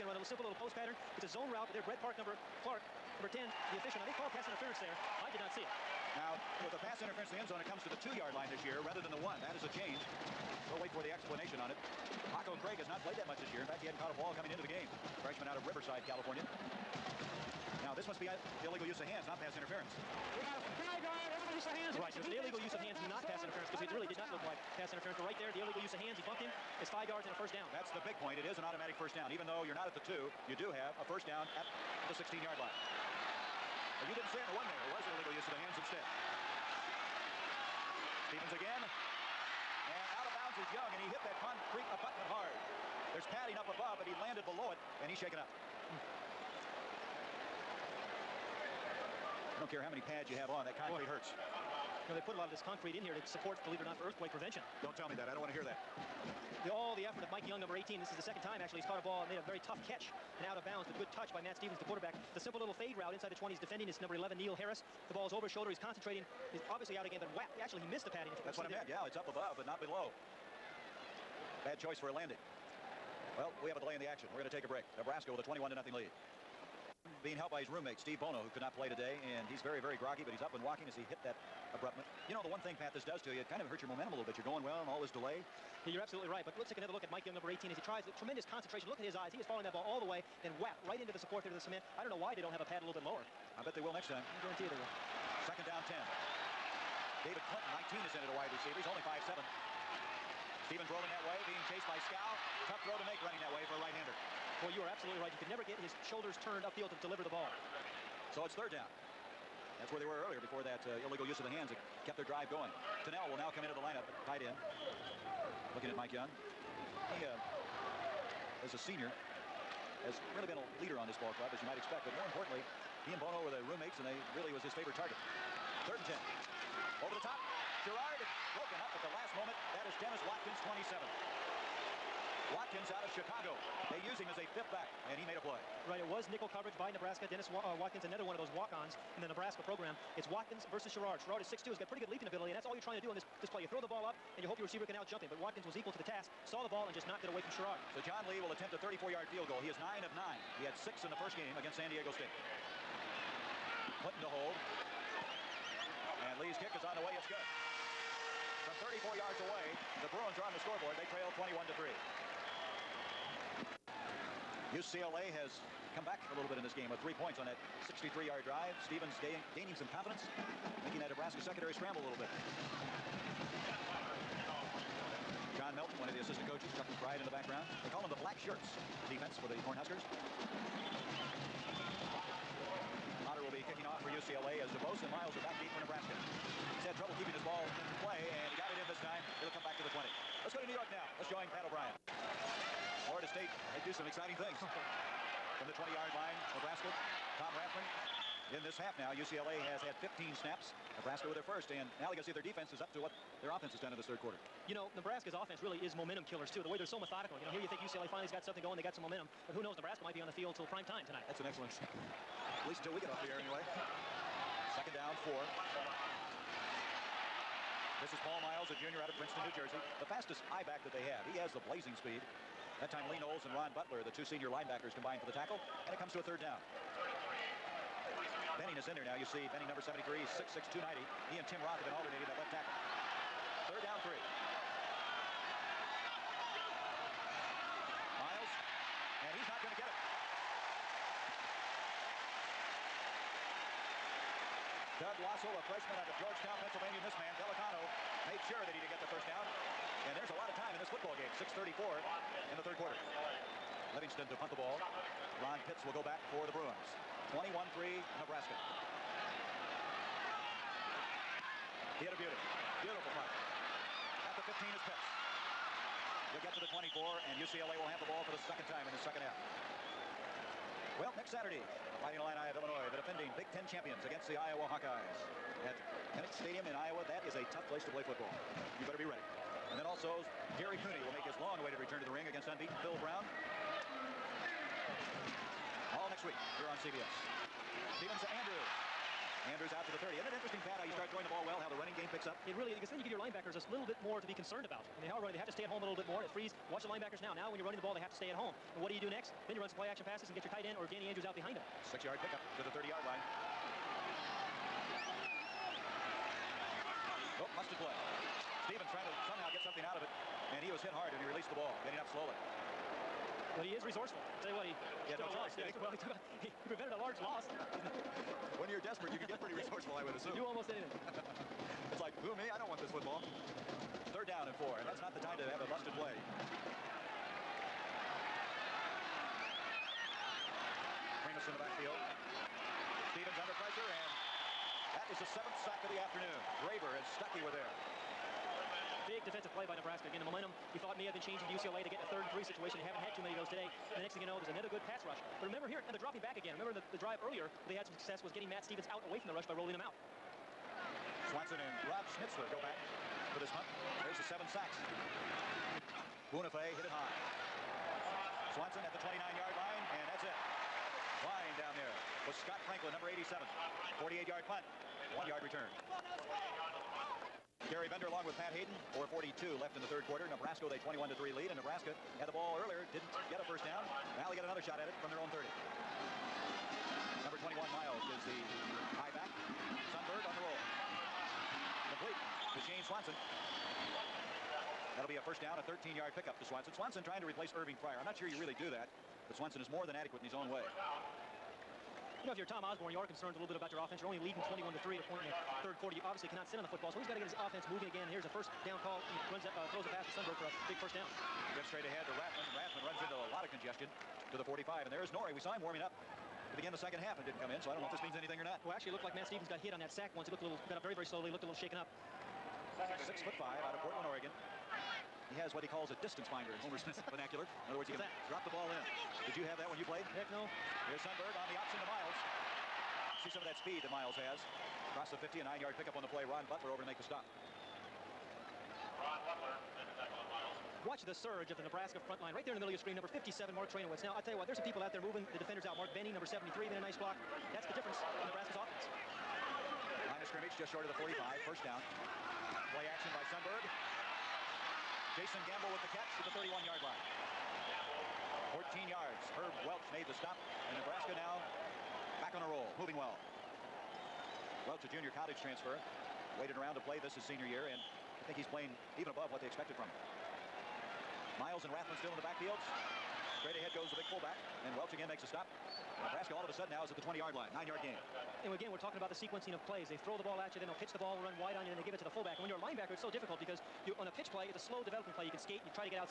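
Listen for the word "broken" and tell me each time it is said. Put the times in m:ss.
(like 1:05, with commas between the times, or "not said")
2:08.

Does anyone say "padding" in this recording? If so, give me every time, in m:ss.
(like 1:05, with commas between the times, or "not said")
0:43, 1:08.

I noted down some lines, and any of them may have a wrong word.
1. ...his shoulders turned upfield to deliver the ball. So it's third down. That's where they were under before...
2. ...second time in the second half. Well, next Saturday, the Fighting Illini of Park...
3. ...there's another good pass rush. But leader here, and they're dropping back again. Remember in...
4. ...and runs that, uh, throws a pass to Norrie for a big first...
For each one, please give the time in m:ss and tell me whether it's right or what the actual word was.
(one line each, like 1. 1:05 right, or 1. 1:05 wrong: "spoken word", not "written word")
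1. 1:45 wrong: "earlier", not "under"
2. 4:28 wrong: "Illinois", not "Park"
3. 5:44 wrong: "remember", not "leader"
4. 6:38 wrong: "Sundberg", not "Norrie".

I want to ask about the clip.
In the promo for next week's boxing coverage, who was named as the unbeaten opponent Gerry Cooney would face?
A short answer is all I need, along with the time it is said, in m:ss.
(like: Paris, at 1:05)
Phil Brown, at 4:42.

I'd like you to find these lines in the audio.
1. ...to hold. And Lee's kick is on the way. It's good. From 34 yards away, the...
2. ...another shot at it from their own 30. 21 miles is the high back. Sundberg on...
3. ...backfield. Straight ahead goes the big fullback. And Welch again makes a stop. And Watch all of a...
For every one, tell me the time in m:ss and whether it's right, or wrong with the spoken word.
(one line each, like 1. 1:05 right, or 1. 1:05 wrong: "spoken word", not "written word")
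1. 2:34 right
2. 6:14 right
3. 7:42 wrong: "Nebraska", not "Watch".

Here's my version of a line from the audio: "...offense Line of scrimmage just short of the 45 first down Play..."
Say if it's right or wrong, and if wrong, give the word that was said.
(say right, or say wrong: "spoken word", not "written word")
right.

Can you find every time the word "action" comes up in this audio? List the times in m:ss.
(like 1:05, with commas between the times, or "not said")
1:14, 4:59, 7:22.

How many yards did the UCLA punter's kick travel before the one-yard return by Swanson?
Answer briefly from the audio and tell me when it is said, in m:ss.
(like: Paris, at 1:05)
48, at 6:04.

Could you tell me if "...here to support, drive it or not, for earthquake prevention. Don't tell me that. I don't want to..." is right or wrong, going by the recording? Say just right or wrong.
wrong.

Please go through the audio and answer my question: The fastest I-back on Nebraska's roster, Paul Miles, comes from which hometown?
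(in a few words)
Princeton, New Jersey.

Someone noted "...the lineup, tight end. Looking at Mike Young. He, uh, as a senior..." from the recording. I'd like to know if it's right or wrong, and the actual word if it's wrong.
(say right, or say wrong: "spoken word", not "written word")
right.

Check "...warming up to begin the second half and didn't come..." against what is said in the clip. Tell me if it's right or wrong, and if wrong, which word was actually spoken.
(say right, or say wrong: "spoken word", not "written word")
right.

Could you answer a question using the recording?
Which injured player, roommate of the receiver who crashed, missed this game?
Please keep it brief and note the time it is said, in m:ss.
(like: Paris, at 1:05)
Steve Bono, at 1:17.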